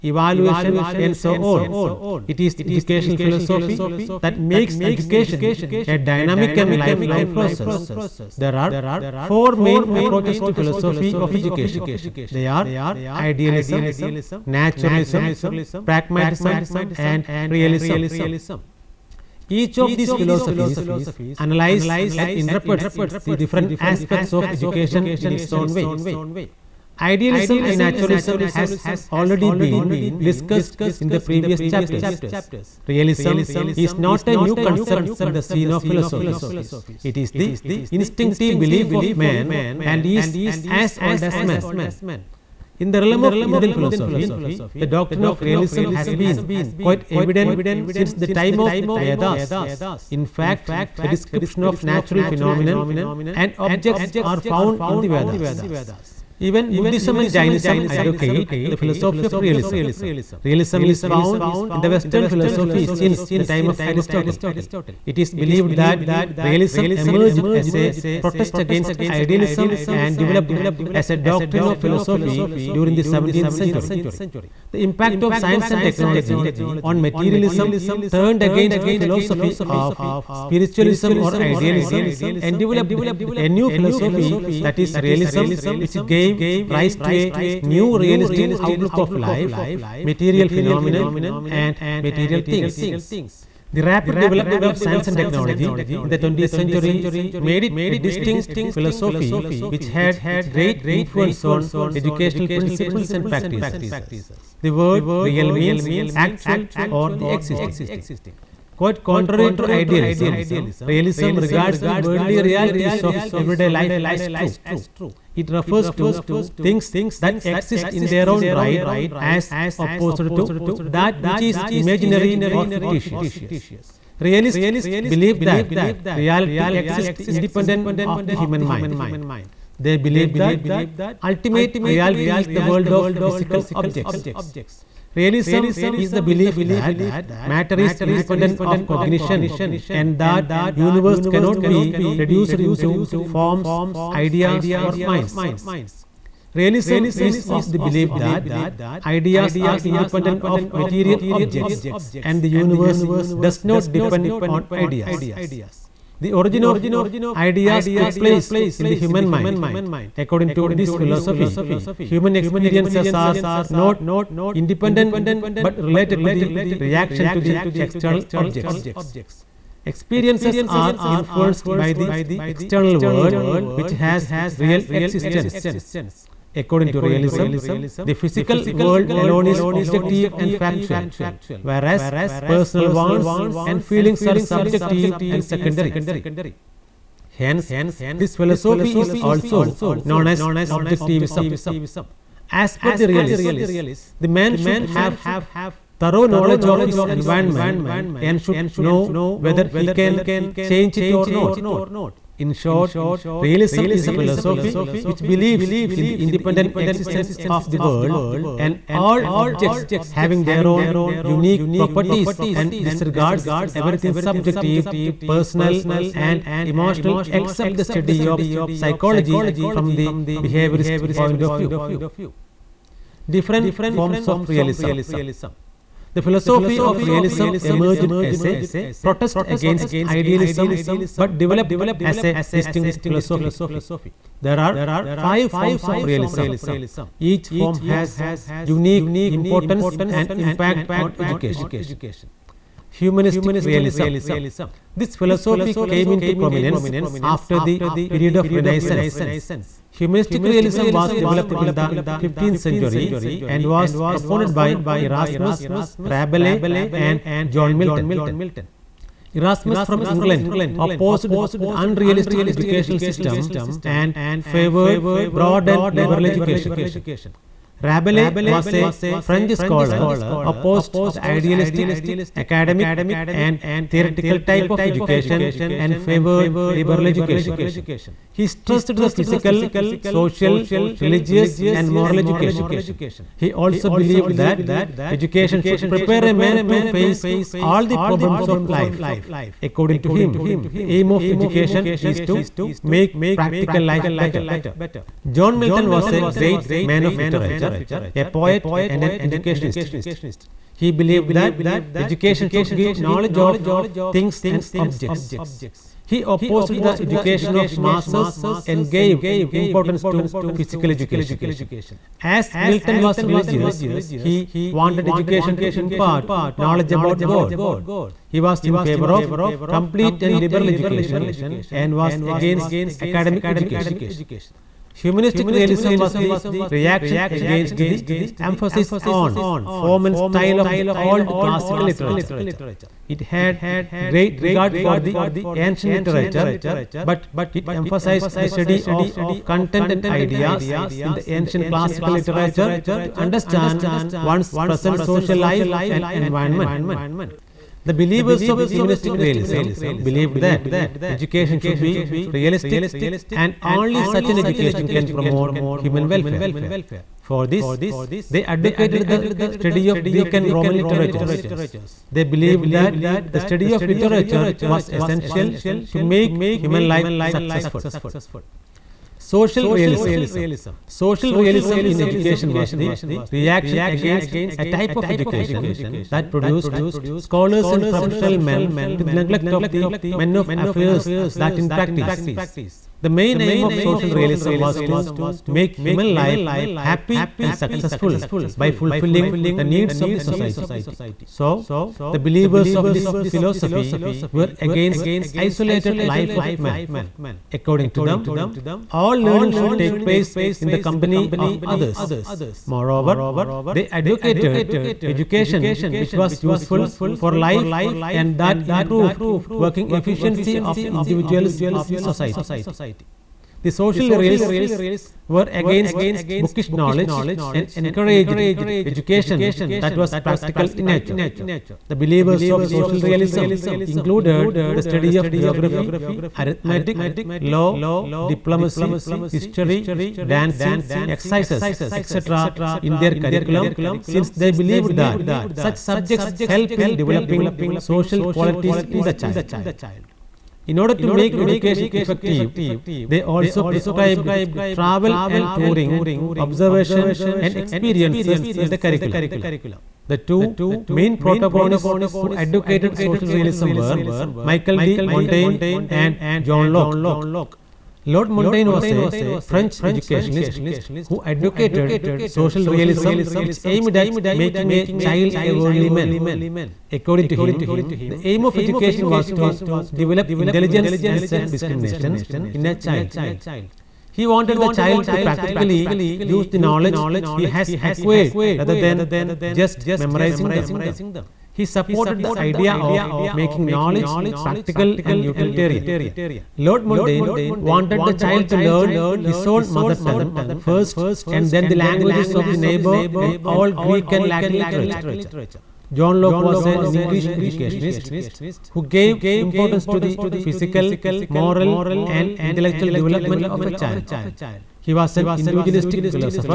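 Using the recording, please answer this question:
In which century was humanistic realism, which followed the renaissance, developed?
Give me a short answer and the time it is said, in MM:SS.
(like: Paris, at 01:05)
15th century, at 04:12.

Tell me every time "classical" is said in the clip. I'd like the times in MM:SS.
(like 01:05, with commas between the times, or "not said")
05:31, 05:41.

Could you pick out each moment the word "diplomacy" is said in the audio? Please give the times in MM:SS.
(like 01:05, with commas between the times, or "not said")
07:08.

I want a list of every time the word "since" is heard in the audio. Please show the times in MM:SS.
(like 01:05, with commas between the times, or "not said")
00:47, 01:02, 07:13.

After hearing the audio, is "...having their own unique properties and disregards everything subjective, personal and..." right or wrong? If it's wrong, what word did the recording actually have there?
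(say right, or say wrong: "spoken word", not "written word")
right.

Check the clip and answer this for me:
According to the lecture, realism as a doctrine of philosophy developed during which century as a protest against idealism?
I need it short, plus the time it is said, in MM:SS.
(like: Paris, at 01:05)
17th century, at 01:13.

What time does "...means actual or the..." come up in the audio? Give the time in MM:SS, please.
01:45.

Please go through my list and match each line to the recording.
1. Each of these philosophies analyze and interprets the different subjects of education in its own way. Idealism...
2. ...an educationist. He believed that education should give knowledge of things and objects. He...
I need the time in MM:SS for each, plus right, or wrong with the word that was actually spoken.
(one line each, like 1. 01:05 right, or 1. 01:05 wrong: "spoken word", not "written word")
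1. 00:19 wrong: "aspects", not "subjects"
2. 04:59 right.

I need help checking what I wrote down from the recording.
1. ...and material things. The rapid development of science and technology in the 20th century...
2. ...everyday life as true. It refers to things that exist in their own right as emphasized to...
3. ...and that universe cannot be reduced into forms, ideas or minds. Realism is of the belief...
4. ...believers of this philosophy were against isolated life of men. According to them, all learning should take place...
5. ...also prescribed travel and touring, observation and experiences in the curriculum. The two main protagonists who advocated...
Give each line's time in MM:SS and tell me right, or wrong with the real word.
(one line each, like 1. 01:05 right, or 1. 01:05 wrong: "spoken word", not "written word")
1. 01:31 right
2. 01:53 wrong: "opposed", not "emphasized"
3. 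02:19 right
4. 06:32 right
5. 07:23 right.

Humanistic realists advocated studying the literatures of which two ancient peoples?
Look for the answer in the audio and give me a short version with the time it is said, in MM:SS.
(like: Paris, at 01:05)
Greek and Roman, at 06:00.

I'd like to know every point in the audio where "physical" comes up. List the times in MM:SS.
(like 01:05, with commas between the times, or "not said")
02:13, 02:58, 04:39, 05:10, 08:20.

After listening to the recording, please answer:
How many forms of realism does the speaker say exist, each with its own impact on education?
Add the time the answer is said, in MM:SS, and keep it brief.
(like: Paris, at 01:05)
5, at 03:55.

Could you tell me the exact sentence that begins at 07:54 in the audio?
He wanted the child to practically use the knowledge he has acquired rather than just memorizing them.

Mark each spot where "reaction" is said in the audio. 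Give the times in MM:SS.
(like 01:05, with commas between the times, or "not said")
02:46, 05:26, 06:13.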